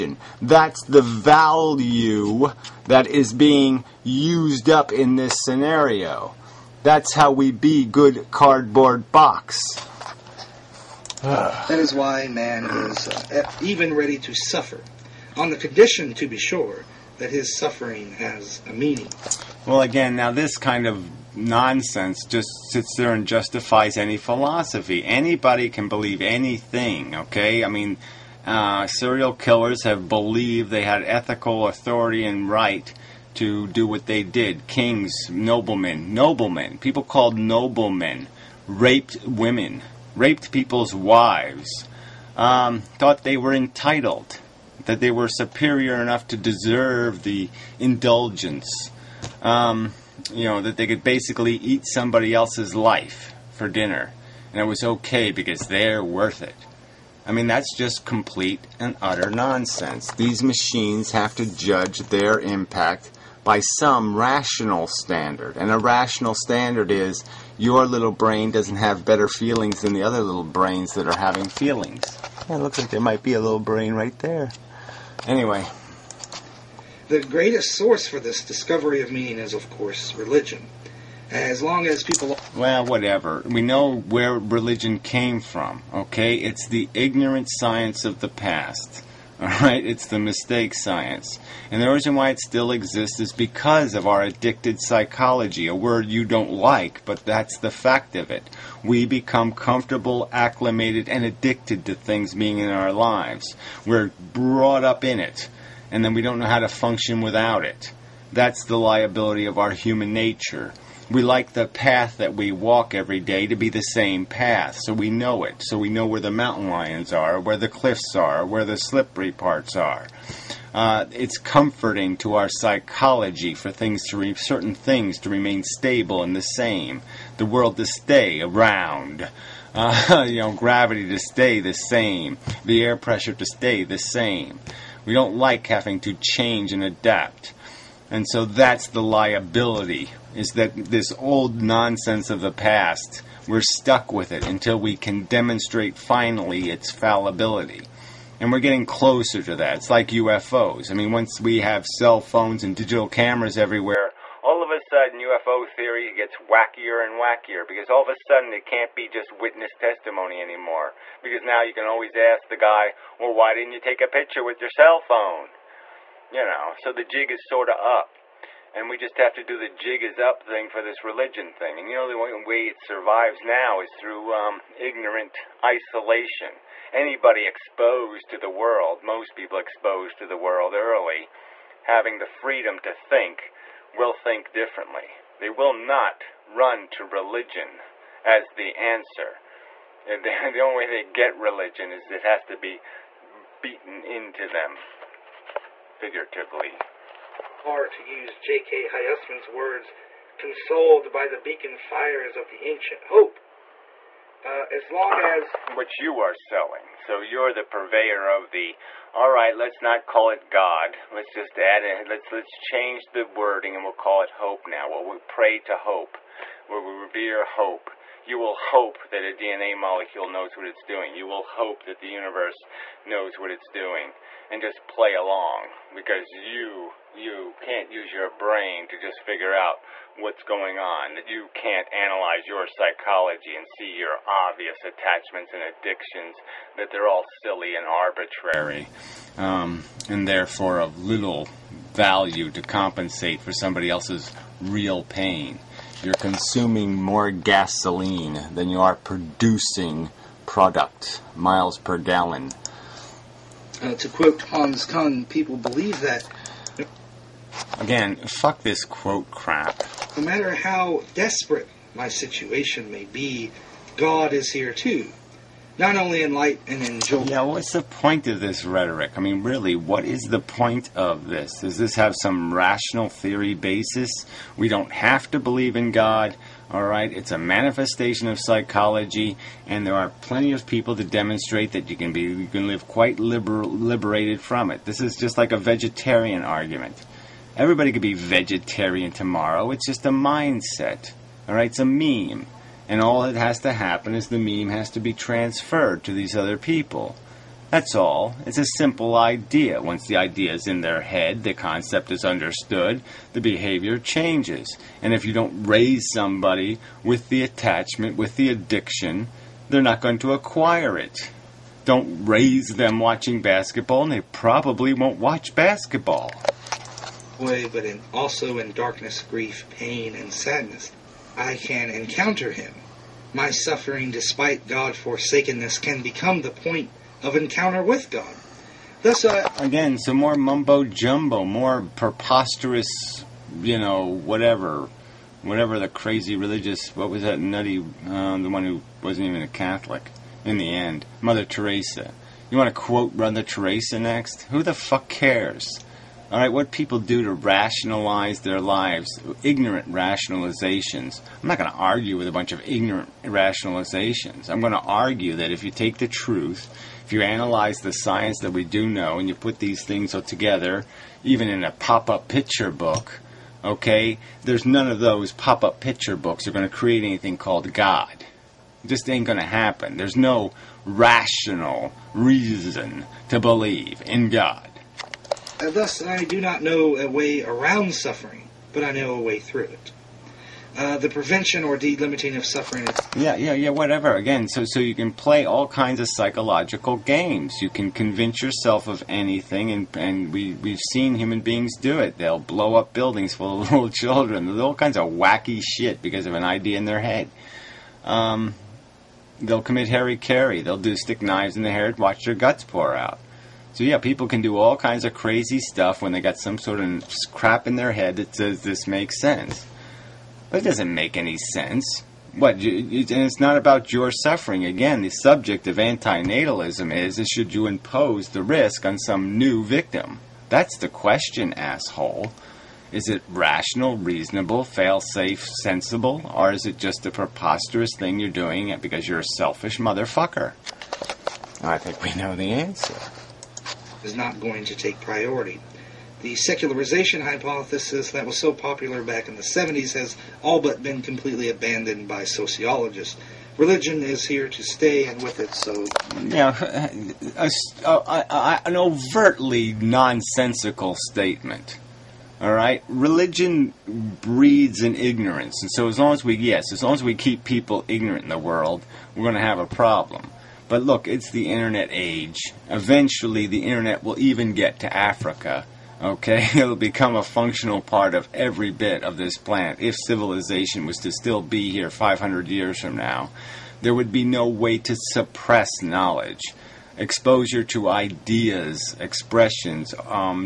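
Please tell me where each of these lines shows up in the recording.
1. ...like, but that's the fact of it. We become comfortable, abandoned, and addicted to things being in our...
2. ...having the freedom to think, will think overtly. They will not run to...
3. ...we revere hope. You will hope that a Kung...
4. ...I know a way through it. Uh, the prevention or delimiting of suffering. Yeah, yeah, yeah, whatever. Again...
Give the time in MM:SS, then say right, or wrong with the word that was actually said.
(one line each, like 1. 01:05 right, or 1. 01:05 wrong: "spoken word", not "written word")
1. 01:36 wrong: "acclimated", not "abandoned"
2. 03:01 wrong: "differently", not "overtly"
3. 03:36 wrong: "DNA", not "Kung"
4. 06:18 right.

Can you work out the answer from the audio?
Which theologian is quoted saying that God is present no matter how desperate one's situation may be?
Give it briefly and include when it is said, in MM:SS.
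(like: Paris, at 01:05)
Hans Kung, at 04:14.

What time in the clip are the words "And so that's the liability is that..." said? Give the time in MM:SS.
02:18.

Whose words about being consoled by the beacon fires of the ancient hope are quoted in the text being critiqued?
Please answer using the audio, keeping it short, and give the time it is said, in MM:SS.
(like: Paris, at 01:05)
J.K. Hyusman, at 03:18.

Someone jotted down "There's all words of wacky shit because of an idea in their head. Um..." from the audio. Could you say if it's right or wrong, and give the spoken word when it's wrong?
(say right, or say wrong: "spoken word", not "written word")
wrong: "kinds", not "words".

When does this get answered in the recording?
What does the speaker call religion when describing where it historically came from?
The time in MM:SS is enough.
01:26.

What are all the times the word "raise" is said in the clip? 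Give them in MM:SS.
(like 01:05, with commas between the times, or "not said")
05:05, 05:12.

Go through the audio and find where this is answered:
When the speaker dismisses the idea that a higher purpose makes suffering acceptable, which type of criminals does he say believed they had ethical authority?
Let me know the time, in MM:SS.
00:28.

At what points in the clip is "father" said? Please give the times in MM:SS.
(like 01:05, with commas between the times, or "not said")
not said.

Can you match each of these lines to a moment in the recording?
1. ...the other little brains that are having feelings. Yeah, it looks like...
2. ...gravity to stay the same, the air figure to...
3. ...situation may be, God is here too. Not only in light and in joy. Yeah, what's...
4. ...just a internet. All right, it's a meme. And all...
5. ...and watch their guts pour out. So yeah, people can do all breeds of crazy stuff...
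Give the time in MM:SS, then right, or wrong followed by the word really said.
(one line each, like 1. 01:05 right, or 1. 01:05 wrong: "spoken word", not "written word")
1. 01:09 right
2. 02:10 wrong: "pressure", not "figure"
3. 04:22 right
4. 04:49 wrong: "mindset", not "internet"
5. 06:41 wrong: "kinds", not "breeds".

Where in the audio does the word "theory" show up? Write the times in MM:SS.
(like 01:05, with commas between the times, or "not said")
02:35, 04:33.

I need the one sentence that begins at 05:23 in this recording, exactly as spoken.
My suffering, despite God forsakenness, can become the point of encounter with God.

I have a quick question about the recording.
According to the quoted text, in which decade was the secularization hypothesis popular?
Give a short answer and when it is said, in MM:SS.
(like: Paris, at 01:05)
1970s, at 07:19.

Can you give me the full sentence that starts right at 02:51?
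And you know, the only way it survives now is through um, ignorant isolation.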